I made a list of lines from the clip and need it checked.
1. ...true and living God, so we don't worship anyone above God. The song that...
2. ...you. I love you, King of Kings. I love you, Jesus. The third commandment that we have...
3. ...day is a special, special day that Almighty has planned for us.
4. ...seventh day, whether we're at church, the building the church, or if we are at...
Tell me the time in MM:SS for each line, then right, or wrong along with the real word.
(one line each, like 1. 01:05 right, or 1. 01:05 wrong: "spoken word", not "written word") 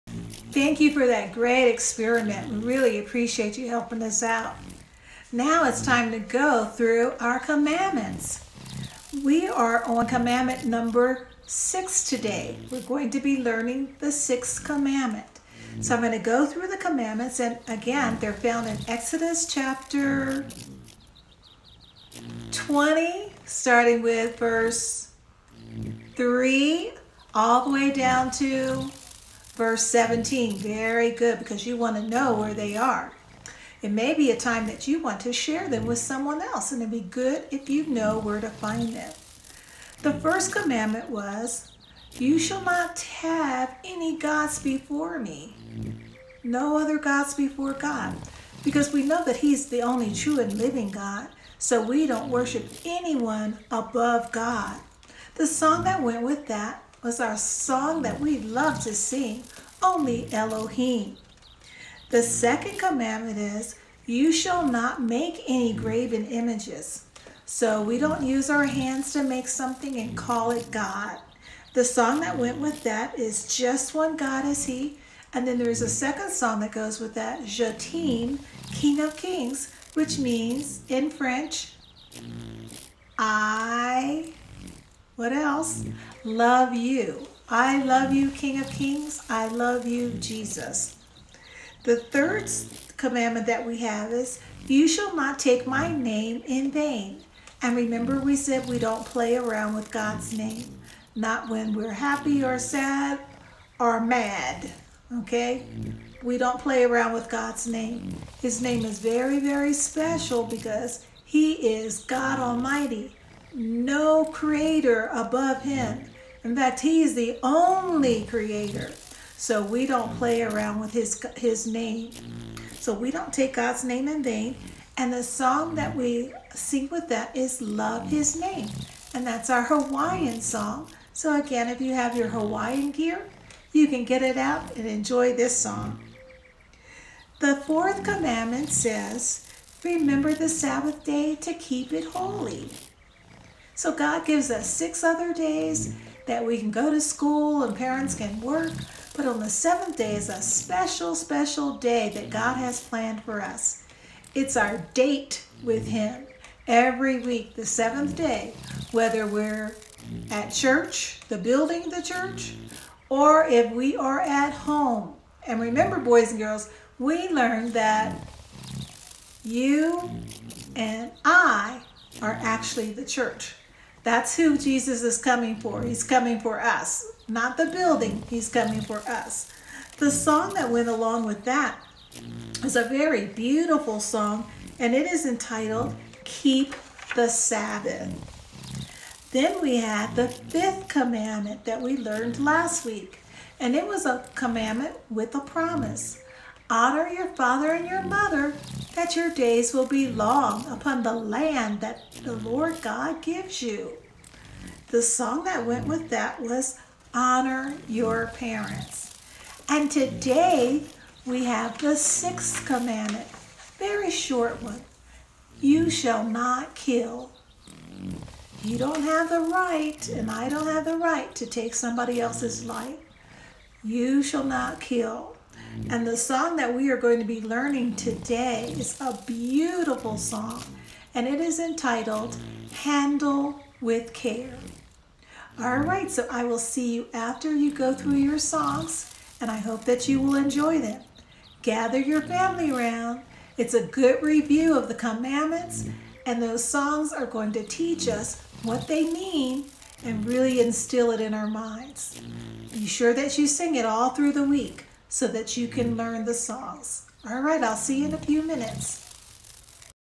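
1. 00:50 right
2. 01:26 right
3. 02:29 wrong: "God", not "Almighty"
4. 02:37 right.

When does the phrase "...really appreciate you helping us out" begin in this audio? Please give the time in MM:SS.
00:02.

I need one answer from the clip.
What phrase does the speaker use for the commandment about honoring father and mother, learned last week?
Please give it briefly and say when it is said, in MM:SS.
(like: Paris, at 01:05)
A commandment with a promise, at 03:14.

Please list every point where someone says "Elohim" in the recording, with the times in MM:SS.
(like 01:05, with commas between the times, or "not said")
01:00.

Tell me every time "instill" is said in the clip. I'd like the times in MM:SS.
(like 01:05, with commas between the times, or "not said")
04:10.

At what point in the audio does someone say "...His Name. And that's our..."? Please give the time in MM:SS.
02:08.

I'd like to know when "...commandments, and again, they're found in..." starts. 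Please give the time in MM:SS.
00:16.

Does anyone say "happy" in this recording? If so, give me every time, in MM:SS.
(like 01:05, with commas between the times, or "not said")
01:41.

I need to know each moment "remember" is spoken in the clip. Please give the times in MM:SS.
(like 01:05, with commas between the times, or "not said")
01:37, 02:19, 02:45.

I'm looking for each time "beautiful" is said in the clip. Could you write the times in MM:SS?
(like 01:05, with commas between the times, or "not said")
03:03, 03:49.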